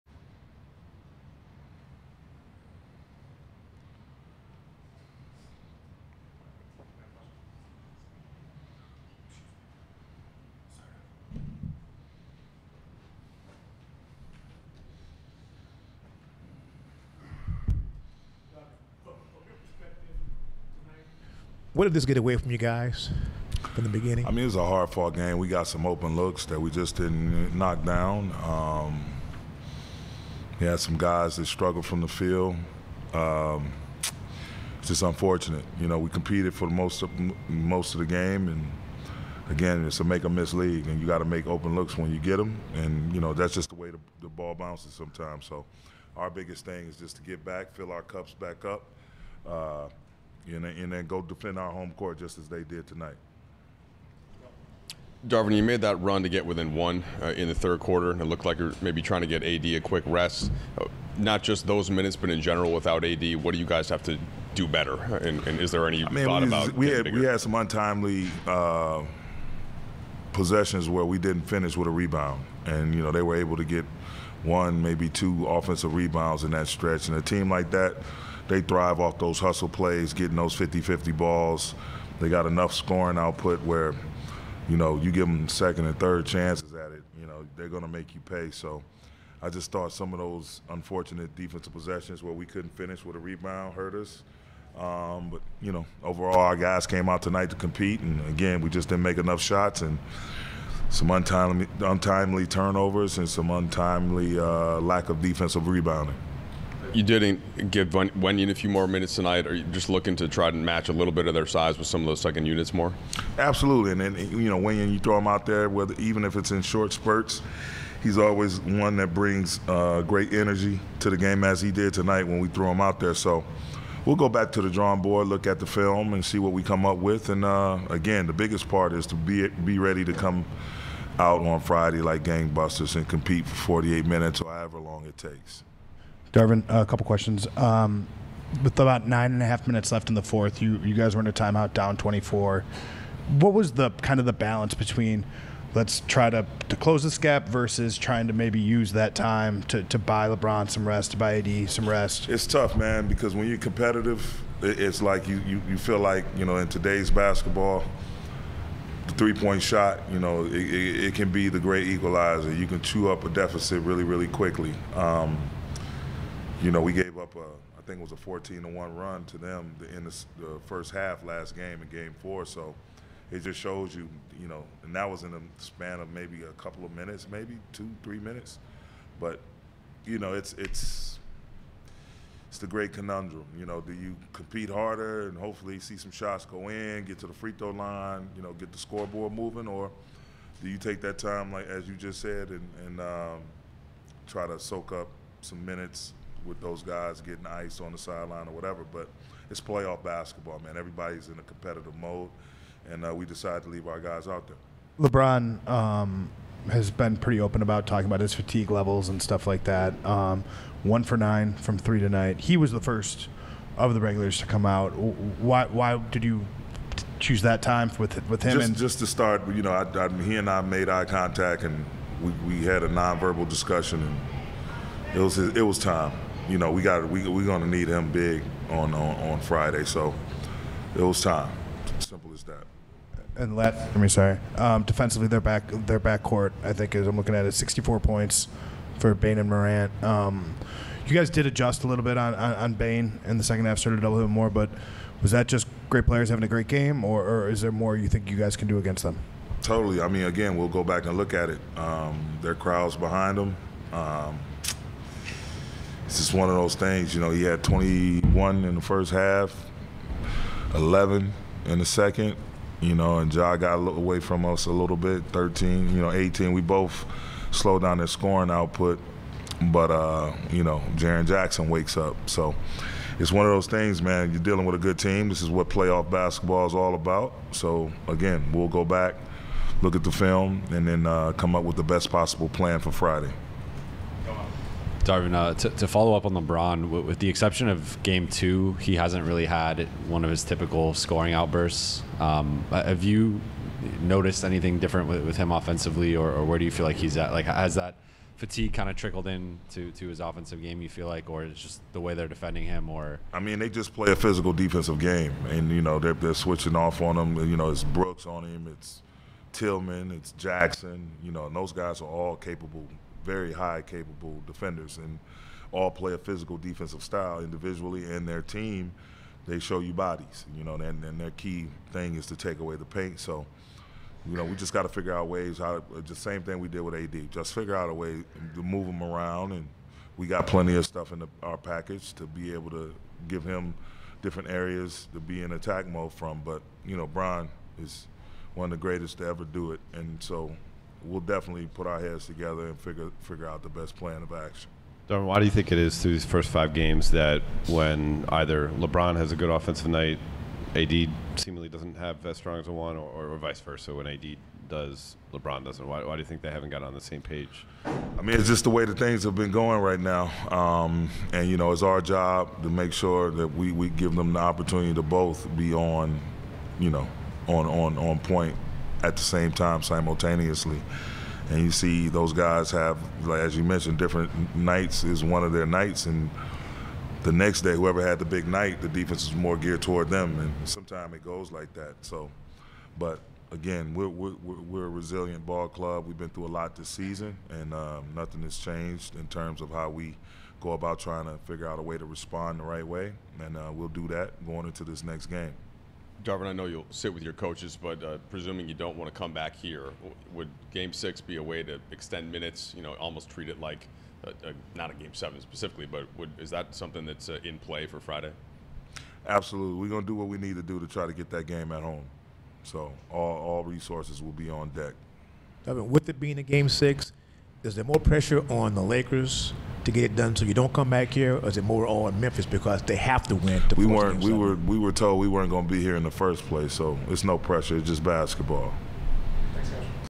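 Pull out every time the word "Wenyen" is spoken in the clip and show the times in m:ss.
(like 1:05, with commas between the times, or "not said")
1:47, 1:54.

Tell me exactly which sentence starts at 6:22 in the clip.
So, but again, we're, we're, we're a resilient ball club.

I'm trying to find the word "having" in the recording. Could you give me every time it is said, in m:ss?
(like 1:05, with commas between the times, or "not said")
4:06.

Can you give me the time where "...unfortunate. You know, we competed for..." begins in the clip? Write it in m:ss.
0:35.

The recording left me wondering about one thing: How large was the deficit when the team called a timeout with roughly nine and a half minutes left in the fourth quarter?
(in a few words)
24.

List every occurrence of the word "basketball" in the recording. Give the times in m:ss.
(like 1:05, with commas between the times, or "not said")
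2:37, 3:20, 4:36, 7:08.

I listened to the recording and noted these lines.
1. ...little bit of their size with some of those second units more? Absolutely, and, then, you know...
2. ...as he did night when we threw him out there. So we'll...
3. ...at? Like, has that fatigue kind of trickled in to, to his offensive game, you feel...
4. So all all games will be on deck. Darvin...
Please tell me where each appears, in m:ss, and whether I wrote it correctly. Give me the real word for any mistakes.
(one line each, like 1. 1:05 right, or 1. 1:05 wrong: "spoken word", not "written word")
1. 1:50 right
2. 2:01 wrong: "tonight", not "night"
3. 4:57 right
4. 6:52 wrong: "resources", not "games".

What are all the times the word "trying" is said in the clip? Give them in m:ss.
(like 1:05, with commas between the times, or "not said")
0:59, 2:27, 6:30.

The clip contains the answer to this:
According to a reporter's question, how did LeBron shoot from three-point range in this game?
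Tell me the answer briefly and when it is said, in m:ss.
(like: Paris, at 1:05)
1 for 9, at 3:30.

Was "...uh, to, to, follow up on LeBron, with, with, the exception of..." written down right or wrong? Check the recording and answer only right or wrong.
right.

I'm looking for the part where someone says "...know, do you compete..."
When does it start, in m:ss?
3:03.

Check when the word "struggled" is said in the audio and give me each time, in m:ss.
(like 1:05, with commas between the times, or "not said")
0:31.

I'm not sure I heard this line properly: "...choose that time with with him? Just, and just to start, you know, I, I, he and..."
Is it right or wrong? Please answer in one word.
right.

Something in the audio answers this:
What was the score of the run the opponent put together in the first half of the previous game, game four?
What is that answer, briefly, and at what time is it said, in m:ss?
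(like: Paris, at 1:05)
14 to 1, at 2:48.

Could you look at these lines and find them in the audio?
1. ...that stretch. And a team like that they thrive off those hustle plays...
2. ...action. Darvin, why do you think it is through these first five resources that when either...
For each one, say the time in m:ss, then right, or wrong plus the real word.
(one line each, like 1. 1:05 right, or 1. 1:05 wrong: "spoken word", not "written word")
1. 1:16 right
2. 5:44 wrong: "games", not "resources".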